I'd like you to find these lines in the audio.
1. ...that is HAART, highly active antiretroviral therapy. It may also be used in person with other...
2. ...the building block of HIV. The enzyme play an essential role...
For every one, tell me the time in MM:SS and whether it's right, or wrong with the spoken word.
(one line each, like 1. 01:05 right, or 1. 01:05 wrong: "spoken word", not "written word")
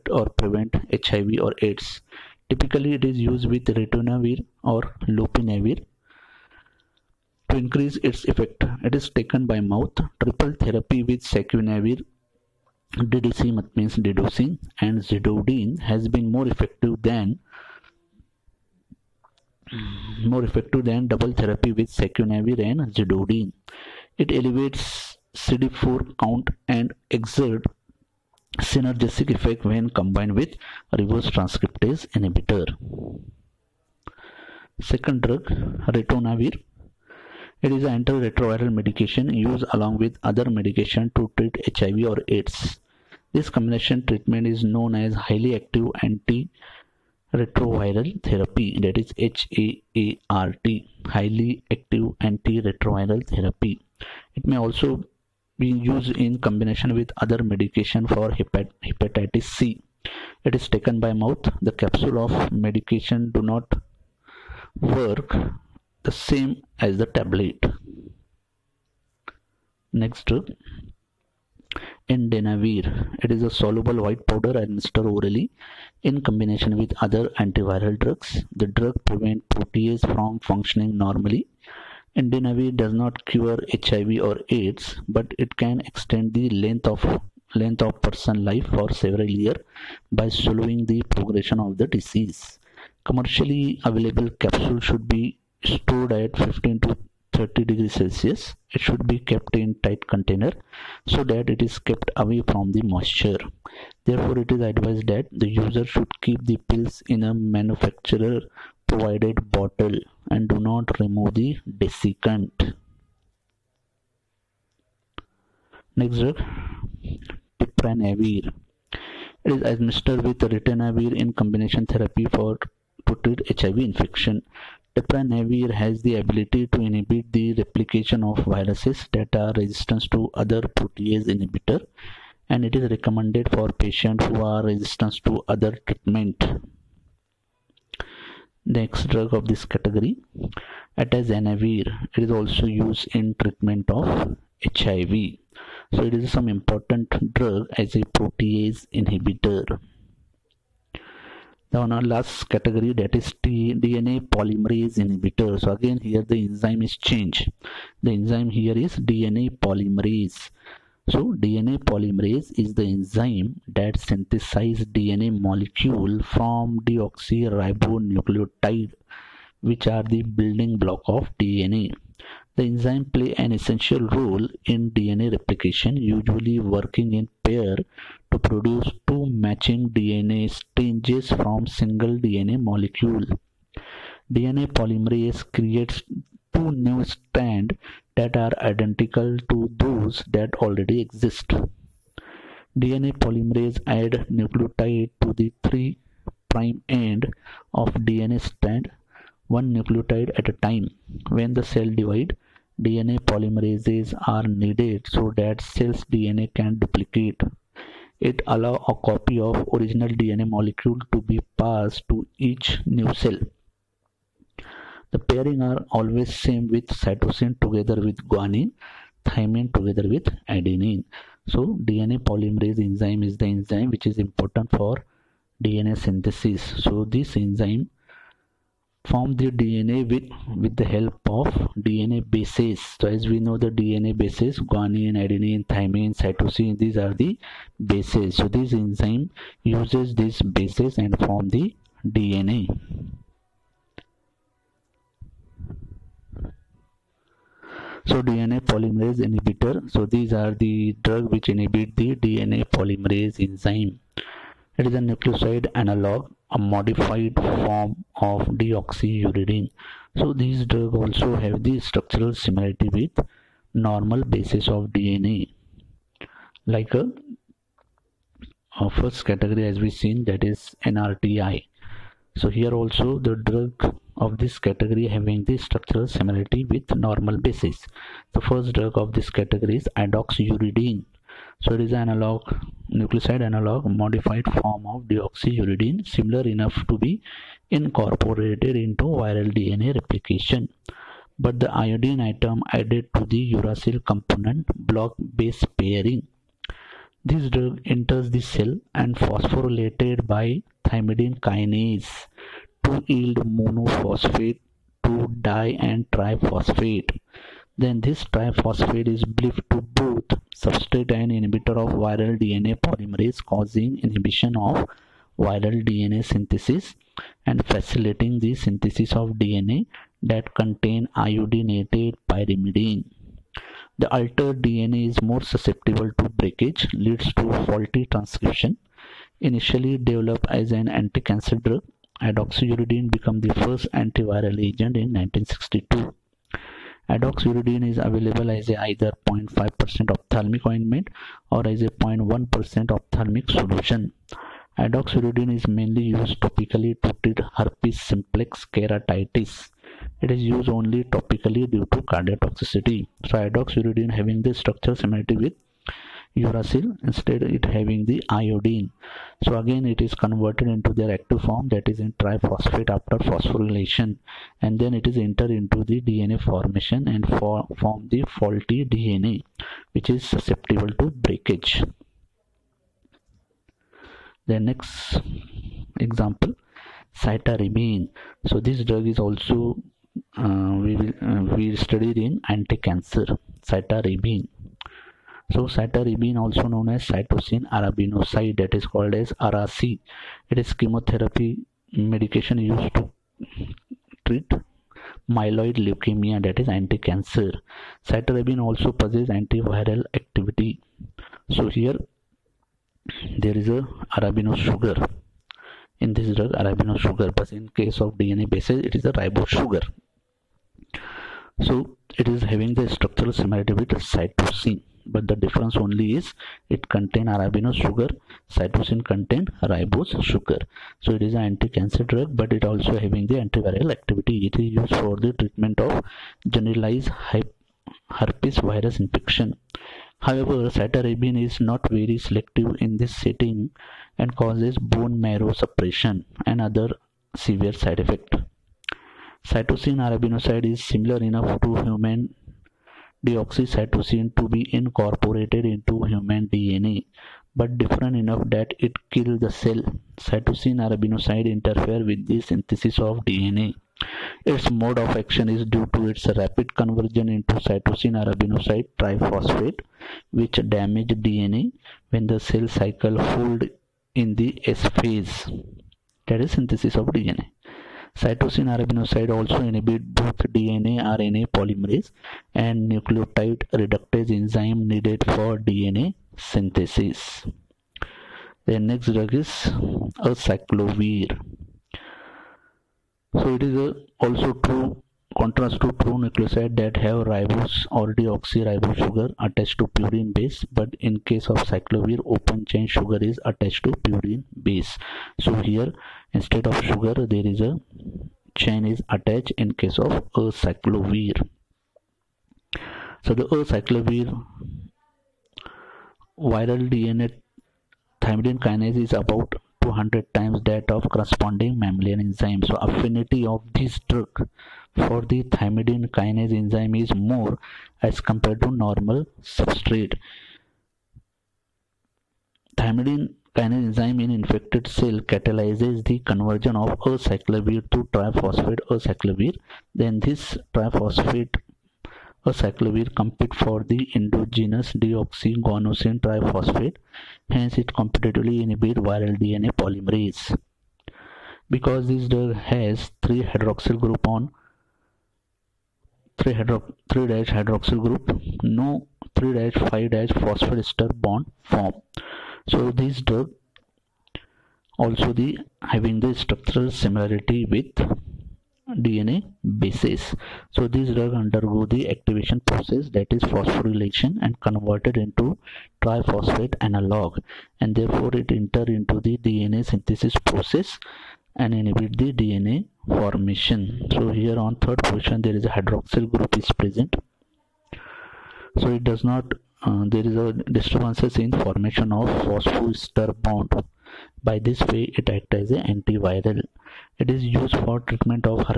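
1. 00:48 wrong: "combination", not "person"
2. 02:50 wrong: "DNA", not "HIV".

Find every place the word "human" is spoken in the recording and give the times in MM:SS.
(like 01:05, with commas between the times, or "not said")
07:21, 07:26.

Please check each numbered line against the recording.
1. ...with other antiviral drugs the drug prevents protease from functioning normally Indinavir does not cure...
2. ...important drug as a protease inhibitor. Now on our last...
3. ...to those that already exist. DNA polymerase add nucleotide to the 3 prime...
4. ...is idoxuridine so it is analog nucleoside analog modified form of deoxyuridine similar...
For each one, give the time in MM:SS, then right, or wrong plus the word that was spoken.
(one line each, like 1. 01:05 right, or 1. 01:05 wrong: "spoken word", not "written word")
1. 01:16 right
2. 02:26 right
3. 03:09 right
4. 04:39 right.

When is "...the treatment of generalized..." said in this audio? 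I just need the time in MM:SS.
07:05.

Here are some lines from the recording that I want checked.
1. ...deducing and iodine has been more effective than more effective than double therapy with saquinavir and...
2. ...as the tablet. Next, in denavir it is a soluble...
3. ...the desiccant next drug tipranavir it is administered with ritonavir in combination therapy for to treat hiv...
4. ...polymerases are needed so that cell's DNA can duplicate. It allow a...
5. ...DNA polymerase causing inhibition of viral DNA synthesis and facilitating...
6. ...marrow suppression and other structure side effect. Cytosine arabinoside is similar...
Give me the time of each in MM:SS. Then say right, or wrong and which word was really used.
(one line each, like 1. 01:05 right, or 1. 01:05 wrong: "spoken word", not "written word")
1. 00:13 wrong: "zidovudine", not "iodine"
2. 01:06 right
3. 01:51 right
4. 03:23 right
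5. 05:12 right
6. 07:15 wrong: "severe", not "structure".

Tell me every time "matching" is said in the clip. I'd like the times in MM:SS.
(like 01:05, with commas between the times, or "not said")
02:59.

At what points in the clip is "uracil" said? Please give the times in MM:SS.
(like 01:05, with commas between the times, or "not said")
04:53, 05:56.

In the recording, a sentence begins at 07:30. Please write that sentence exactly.
Cytosine arabinoside interfere with the synthesis of DNA.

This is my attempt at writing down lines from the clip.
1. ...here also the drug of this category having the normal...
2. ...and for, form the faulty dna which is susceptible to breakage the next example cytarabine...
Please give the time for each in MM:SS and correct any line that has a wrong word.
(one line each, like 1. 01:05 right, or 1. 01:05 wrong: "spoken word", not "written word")
1. 04:32 wrong: "structural", not "normal"
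2. 06:07 right.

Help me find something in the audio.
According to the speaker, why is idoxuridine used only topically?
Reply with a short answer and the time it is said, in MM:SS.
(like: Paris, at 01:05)
cardiotoxicity, at 05:52.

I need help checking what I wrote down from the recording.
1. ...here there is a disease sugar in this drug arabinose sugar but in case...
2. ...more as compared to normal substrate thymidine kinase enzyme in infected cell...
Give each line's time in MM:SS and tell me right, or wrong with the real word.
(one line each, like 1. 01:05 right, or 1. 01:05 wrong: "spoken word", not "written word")
1. 06:41 wrong: "arabinose", not "disease"
2. 08:37 right.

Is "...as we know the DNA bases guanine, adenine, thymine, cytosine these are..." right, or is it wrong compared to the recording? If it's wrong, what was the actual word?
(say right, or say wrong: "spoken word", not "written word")
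right.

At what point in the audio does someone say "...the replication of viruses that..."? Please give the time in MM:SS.
02:07.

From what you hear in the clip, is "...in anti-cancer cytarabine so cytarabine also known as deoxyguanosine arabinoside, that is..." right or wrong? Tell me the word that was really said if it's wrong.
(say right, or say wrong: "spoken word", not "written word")
wrong: "cytosine", not "deoxyguanosine".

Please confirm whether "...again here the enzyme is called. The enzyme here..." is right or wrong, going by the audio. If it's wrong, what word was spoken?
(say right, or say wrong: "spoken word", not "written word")
wrong: "changed", not "called".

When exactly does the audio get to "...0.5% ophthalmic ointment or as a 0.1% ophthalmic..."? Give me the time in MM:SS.
05:39.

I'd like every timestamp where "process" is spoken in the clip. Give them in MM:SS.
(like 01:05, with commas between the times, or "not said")
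09:22, 09:30.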